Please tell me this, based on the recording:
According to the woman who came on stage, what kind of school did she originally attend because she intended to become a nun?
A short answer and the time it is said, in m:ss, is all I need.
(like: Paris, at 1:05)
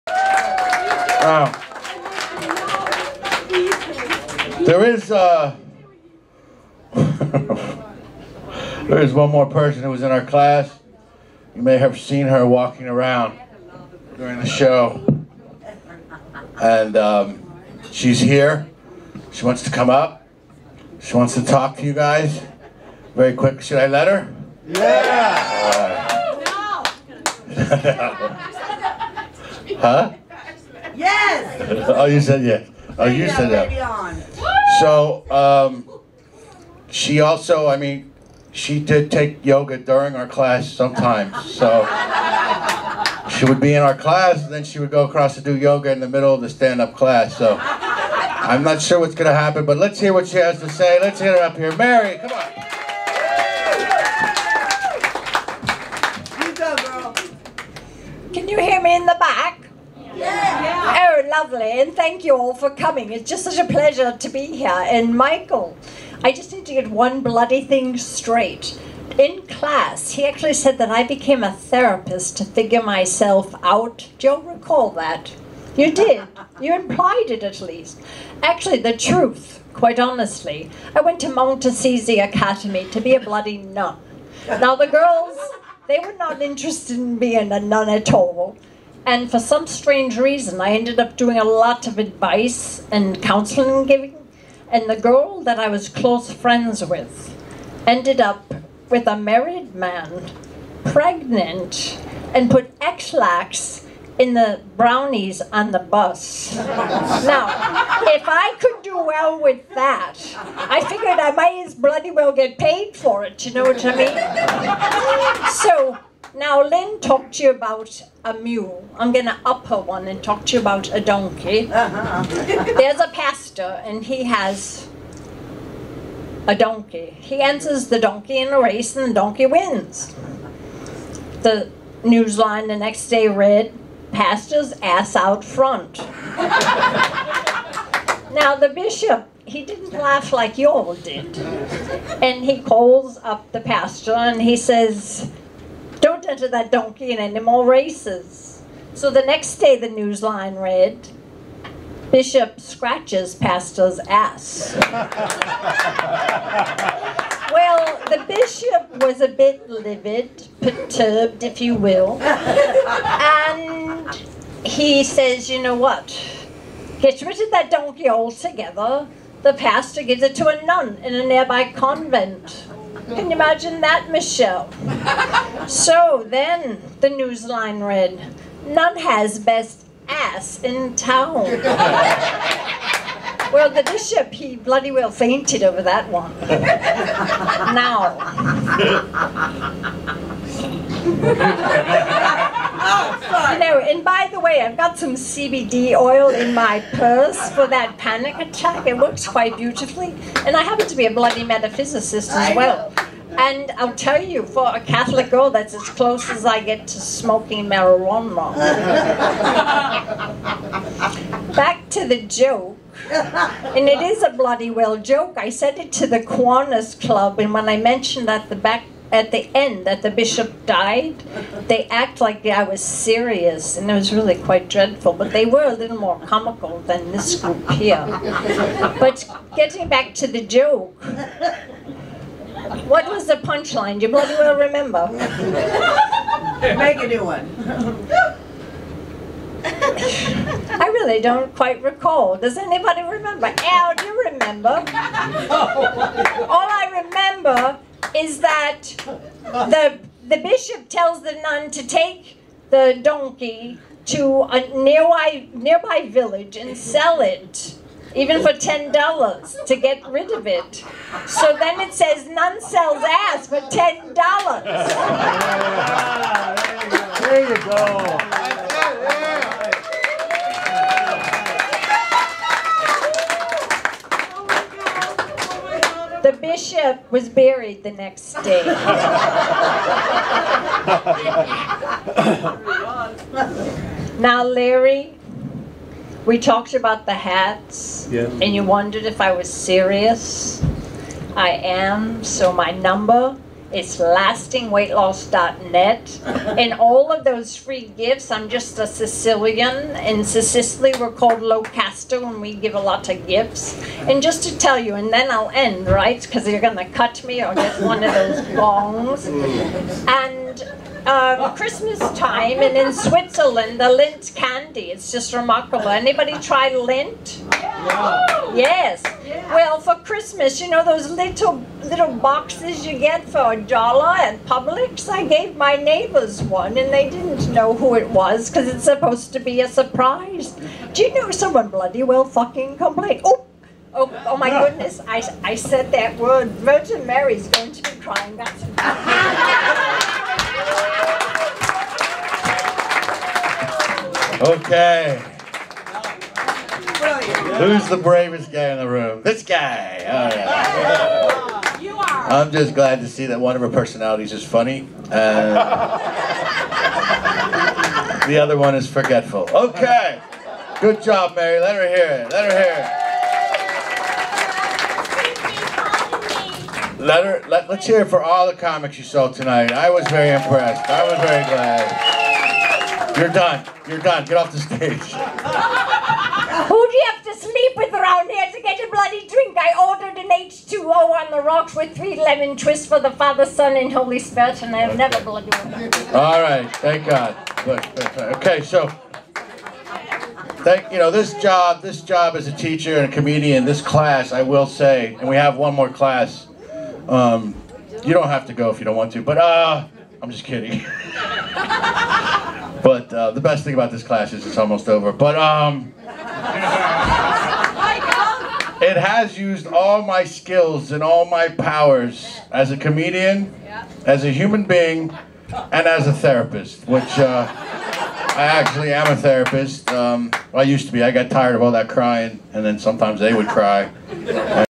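Assisi Academy, at 1:21.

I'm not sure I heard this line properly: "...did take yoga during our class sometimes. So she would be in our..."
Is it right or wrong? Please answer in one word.
right.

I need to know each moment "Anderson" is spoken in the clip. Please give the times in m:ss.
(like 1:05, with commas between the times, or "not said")
not said.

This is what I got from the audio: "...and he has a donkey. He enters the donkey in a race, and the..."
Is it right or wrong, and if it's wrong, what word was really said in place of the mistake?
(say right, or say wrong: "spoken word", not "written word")
right.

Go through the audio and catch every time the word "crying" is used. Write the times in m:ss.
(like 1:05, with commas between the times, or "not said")
5:38, 7:01.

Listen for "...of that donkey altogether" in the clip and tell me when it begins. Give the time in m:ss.
2:47.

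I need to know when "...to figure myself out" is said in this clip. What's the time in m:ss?
1:12.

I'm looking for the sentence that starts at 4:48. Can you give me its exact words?
and you wondered if I was serious.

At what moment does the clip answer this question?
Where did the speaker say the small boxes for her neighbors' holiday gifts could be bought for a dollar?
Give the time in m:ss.
5:24.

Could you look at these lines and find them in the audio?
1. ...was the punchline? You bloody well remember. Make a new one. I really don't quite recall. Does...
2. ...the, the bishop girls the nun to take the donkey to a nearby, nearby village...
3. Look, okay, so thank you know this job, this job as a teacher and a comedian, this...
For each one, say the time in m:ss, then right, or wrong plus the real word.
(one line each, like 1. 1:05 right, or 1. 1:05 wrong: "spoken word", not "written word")
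1. 3:53 right
2. 4:09 wrong: "tells", not "girls"
3. 6:27 right.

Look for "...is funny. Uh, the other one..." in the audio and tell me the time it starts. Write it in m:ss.
5:54.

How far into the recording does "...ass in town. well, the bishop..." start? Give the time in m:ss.
3:00.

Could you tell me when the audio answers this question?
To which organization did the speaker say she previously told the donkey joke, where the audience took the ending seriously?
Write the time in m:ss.
3:36.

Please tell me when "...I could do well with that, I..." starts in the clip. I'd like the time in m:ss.
1:48.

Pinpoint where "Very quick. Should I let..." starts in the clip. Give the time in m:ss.
0:23.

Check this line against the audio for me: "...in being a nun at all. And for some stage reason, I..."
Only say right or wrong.
wrong.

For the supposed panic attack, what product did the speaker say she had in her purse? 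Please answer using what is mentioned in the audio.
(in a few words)
CBD oil.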